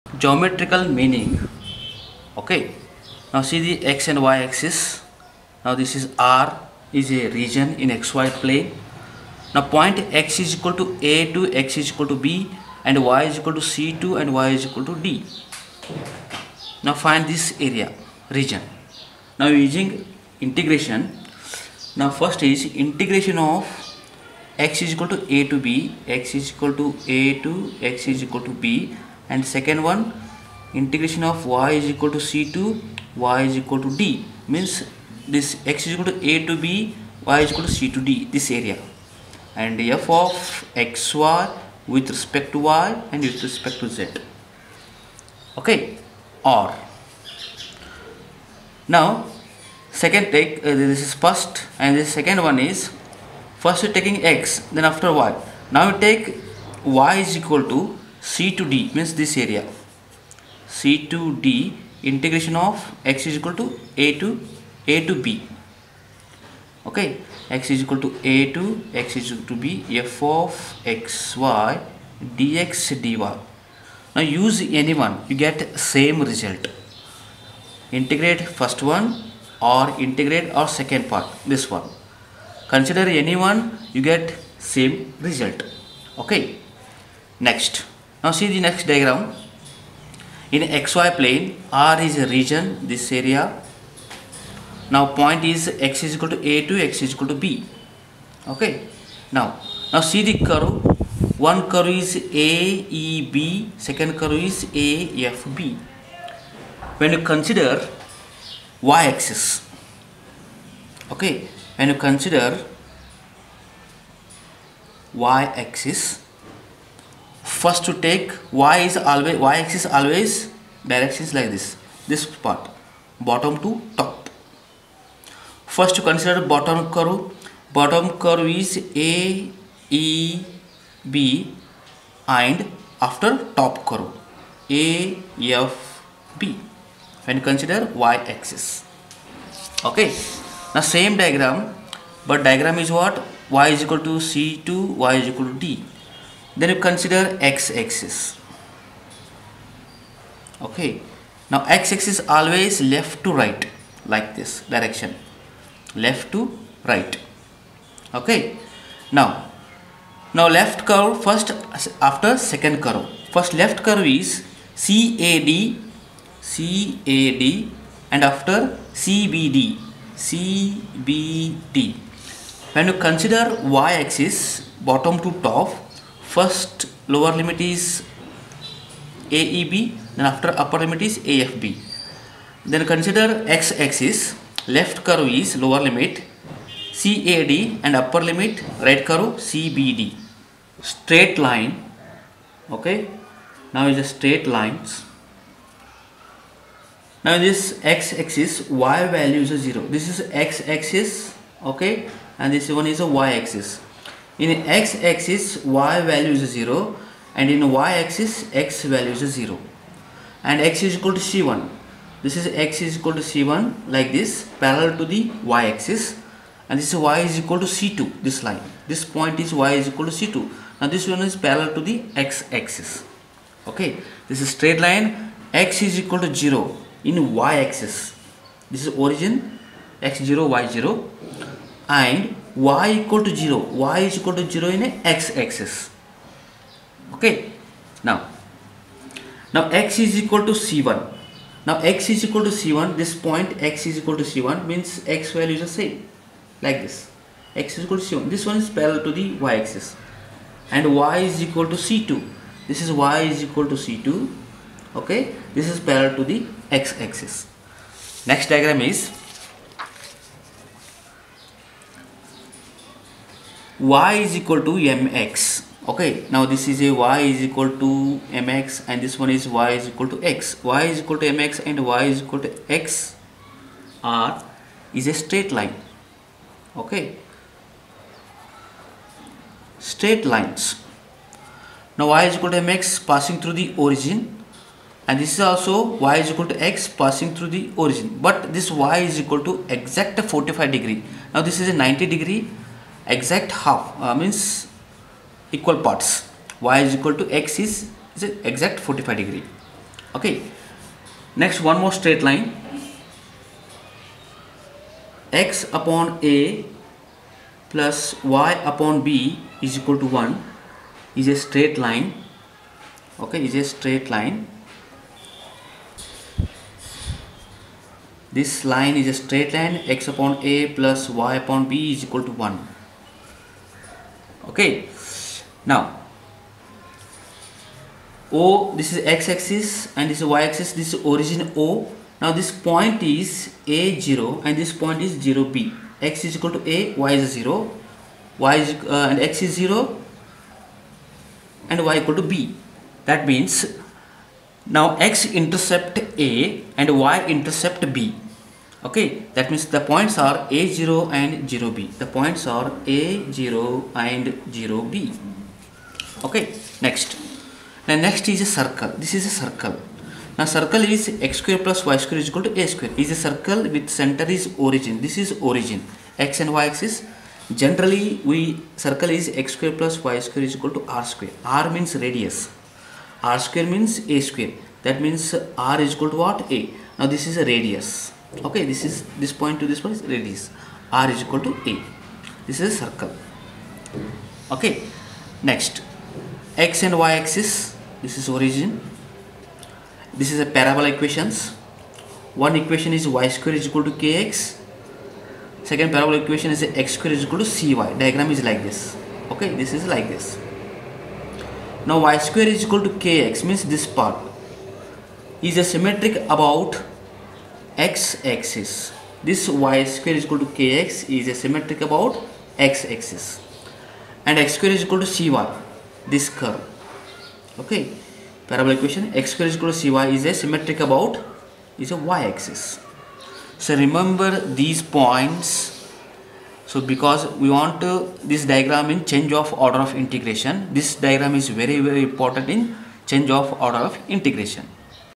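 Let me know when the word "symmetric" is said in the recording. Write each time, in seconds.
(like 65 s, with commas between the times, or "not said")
405 s, 411 s, 420 s.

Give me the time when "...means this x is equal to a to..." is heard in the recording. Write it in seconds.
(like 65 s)
34 s.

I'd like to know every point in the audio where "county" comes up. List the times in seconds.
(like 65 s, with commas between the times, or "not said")
not said.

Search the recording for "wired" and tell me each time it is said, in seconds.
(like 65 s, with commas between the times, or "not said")
not said.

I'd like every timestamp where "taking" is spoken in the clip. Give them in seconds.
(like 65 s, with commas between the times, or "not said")
53 s.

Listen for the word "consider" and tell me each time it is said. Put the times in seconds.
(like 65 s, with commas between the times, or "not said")
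82 s, 107 s, 111 s, 126 s, 137 s, 146 s, 173 s, 182 s.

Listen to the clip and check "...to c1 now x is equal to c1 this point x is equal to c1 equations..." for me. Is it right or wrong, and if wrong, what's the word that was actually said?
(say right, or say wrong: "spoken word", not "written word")
wrong: "means", not "equations".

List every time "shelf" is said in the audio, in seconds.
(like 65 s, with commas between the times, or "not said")
not said.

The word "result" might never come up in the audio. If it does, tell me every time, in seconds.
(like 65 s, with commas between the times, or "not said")
76 s, 85 s.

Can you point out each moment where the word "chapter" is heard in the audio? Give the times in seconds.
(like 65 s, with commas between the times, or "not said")
not said.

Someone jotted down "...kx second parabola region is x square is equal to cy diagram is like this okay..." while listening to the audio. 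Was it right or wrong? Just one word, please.
wrong.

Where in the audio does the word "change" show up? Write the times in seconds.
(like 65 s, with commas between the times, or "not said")
429 s, 433 s.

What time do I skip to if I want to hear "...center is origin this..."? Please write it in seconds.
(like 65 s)
363 s.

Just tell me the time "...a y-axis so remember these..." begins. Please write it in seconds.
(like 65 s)
421 s.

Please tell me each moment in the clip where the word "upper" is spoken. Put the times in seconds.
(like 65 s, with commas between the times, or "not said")
180 s, 188 s.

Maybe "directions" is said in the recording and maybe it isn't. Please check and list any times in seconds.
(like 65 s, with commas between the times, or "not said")
120 s, 154 s.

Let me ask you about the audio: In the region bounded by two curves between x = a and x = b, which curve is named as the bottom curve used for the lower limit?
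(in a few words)
AEB.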